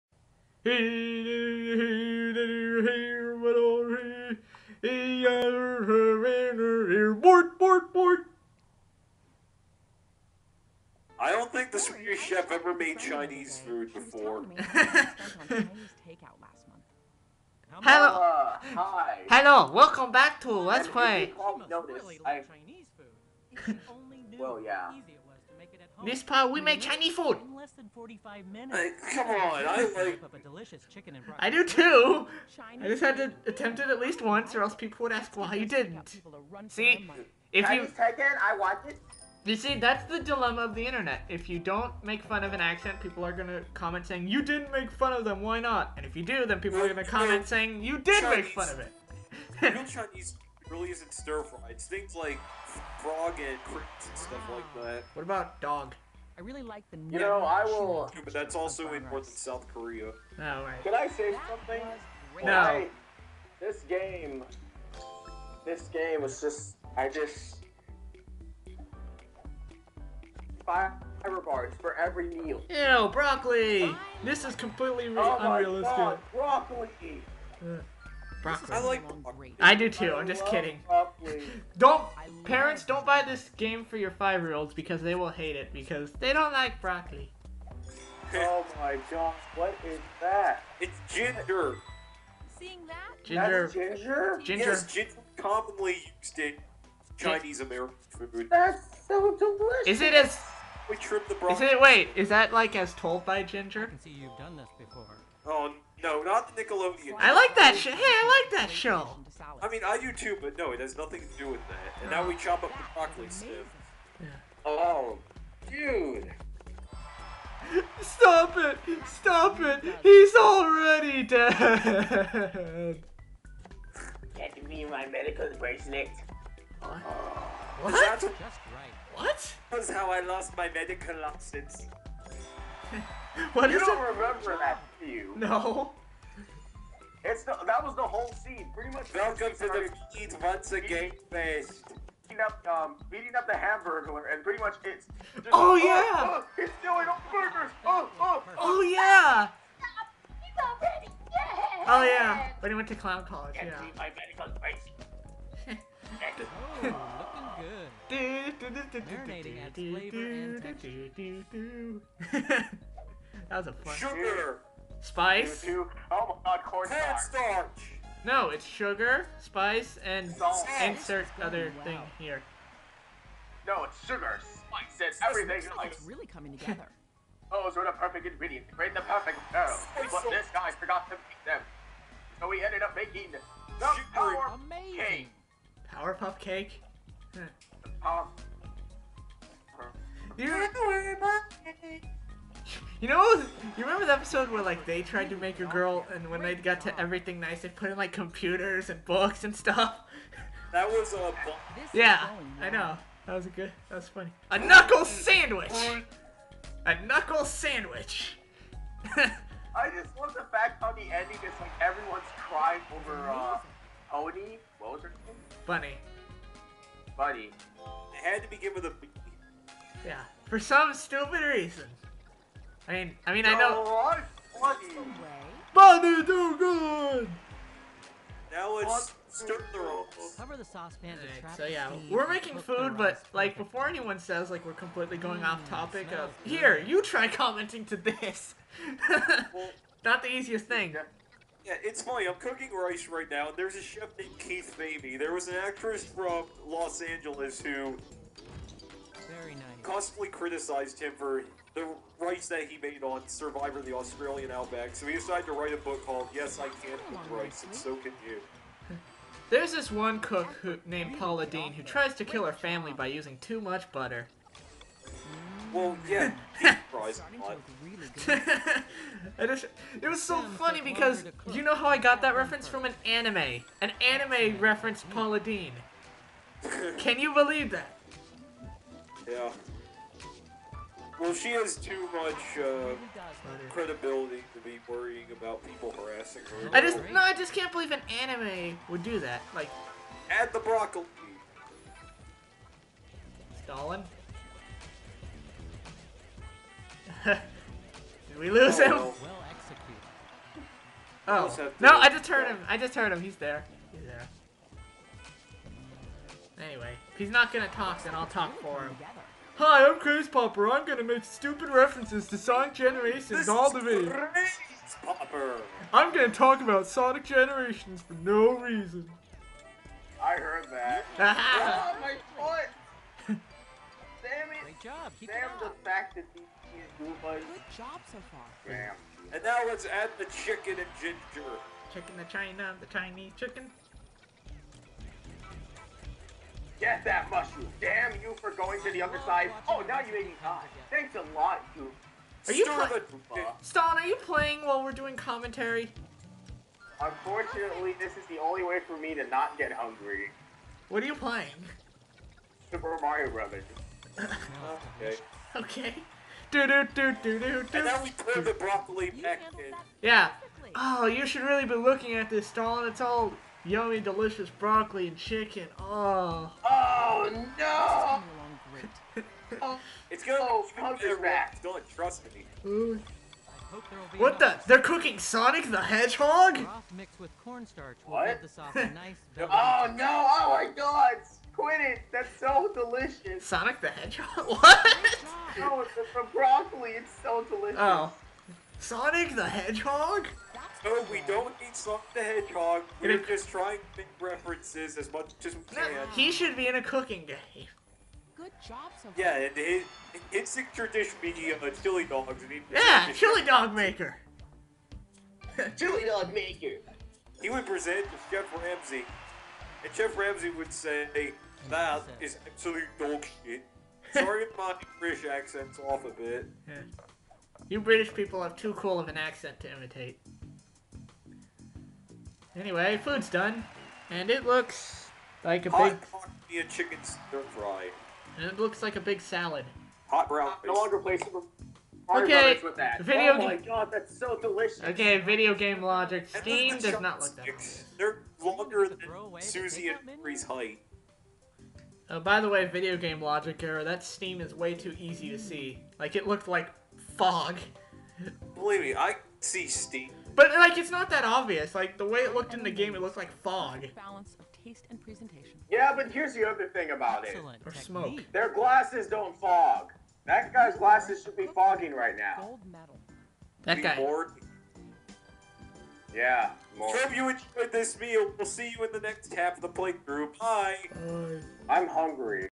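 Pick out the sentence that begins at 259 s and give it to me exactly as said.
There's this one cook who, named Paula Deen who tries to kill her family by using too much butter.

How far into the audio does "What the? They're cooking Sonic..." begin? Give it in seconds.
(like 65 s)
374 s.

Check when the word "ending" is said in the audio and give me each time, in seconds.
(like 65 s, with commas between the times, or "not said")
211 s.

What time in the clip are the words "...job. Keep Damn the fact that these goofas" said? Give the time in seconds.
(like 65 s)
324 s.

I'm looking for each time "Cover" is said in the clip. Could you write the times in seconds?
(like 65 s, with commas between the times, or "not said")
230 s.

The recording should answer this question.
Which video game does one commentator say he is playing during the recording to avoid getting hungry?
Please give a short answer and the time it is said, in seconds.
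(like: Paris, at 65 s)
Super Mario Brothers, at 352 s.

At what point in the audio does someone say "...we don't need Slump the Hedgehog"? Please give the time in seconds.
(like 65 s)
391 s.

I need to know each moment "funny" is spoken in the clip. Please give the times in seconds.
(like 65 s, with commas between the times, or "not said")
204 s, 242 s, 270 s.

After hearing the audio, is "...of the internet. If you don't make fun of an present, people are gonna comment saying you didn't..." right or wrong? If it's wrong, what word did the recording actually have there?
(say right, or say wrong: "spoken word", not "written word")
wrong: "accent", not "present".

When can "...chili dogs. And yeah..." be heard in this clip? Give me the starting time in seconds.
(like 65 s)
401 s.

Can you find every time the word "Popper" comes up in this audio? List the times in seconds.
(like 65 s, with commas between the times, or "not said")
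310 s, 315 s.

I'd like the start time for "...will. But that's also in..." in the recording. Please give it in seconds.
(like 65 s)
57 s.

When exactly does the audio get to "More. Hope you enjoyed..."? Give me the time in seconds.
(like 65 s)
466 s.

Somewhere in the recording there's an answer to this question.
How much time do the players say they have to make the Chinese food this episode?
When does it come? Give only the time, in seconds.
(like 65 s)
27 s.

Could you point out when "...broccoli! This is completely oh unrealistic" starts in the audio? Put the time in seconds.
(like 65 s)
73 s.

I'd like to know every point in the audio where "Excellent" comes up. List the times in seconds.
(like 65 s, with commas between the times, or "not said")
457 s.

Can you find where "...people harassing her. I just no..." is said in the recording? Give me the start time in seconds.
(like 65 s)
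285 s.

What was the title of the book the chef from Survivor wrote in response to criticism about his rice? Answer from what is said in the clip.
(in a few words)
Yes, I Can Cook Rice.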